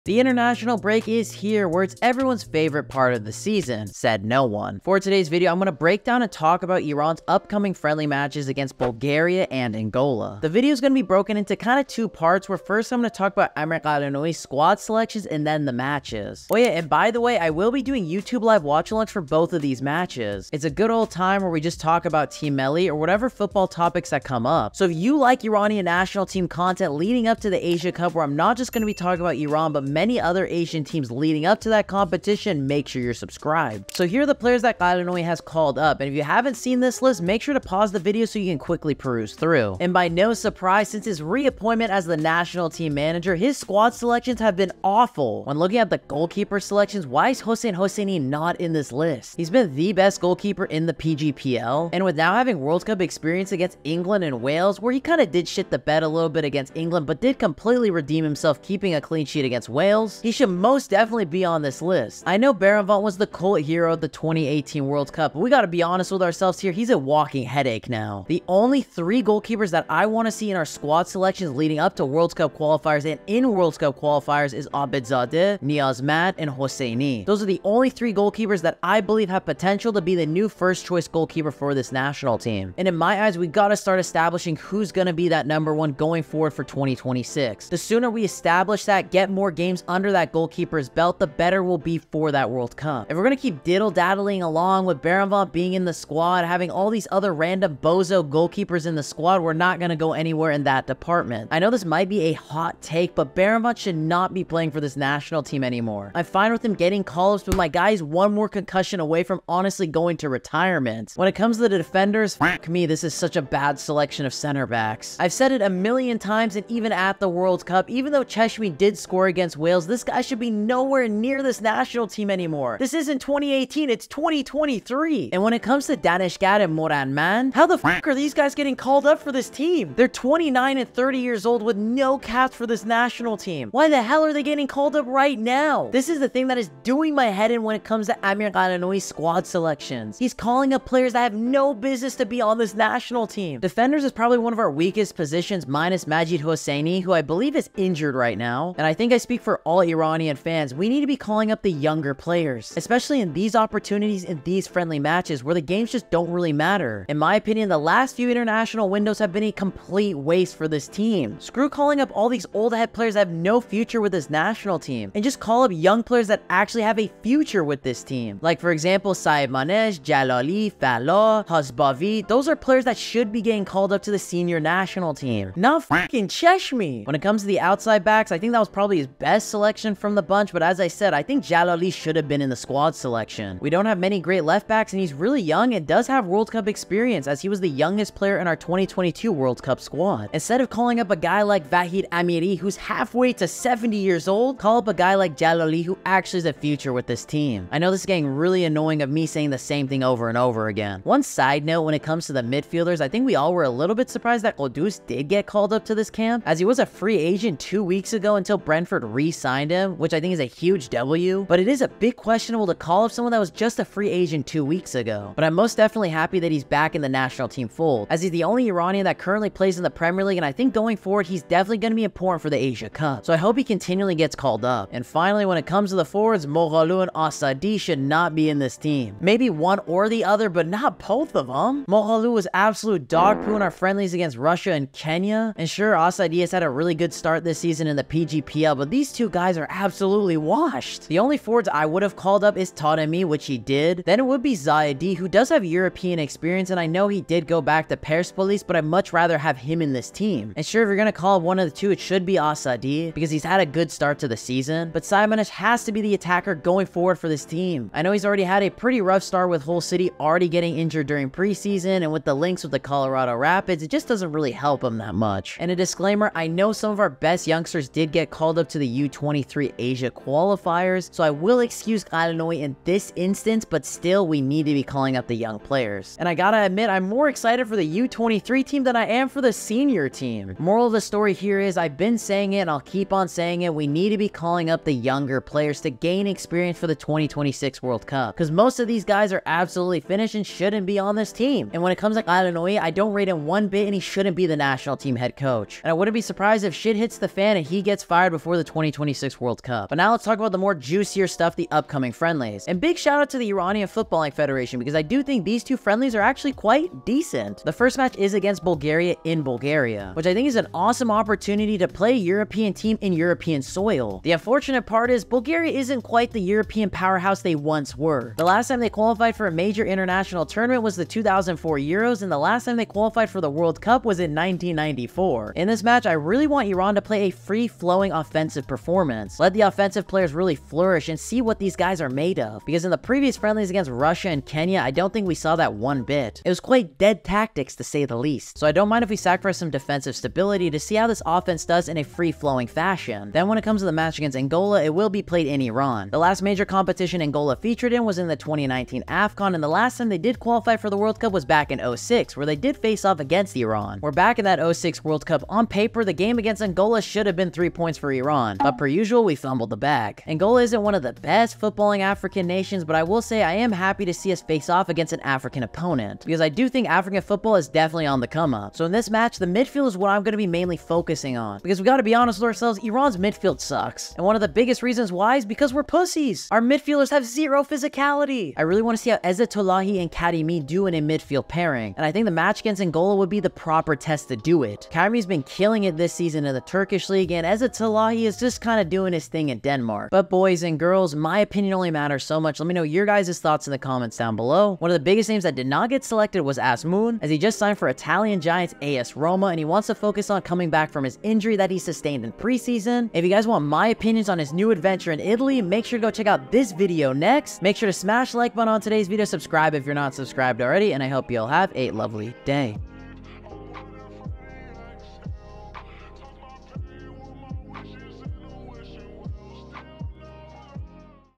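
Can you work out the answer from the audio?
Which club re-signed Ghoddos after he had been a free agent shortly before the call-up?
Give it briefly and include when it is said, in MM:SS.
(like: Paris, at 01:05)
Brentford, at 03:28.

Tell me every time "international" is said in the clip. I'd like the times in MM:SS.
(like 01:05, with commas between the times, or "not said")
00:00, 02:38, 05:19.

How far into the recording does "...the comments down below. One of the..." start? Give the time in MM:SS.
06:33.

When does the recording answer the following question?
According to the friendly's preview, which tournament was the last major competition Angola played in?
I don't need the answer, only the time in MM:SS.
05:48.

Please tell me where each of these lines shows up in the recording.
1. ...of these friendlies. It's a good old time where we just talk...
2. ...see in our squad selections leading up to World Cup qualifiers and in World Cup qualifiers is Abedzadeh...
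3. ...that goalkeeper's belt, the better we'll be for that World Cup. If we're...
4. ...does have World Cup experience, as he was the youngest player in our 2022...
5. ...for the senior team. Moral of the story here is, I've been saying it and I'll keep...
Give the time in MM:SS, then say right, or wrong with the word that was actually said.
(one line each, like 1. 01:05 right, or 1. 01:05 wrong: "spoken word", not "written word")
1. 00:19 wrong: "matches", not "friendlies"
2. 01:10 right
3. 01:30 right
4. 03:05 right
5. 04:39 right.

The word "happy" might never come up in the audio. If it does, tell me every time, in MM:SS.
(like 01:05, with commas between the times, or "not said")
03:36, 06:03.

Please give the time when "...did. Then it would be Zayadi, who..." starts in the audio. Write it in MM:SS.
04:03.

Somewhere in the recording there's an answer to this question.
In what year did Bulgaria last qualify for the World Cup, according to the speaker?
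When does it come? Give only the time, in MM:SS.
05:24.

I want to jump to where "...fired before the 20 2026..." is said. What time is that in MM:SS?
04:58.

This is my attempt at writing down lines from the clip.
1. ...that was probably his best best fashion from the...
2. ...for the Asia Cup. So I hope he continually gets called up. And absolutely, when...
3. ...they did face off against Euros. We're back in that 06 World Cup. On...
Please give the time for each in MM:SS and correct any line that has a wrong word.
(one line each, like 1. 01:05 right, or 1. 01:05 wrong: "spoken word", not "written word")
1. 02:58 wrong: "selection", not "fashion"
2. 03:42 wrong: "finally", not "absolutely"
3. 05:52 wrong: "Iran", not "Euros".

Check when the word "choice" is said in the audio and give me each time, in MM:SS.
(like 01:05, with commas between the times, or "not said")
01:20.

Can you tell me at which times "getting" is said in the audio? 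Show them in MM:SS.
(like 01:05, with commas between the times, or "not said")
01:46, 02:08, 02:14, 02:53, 03:18, 04:20.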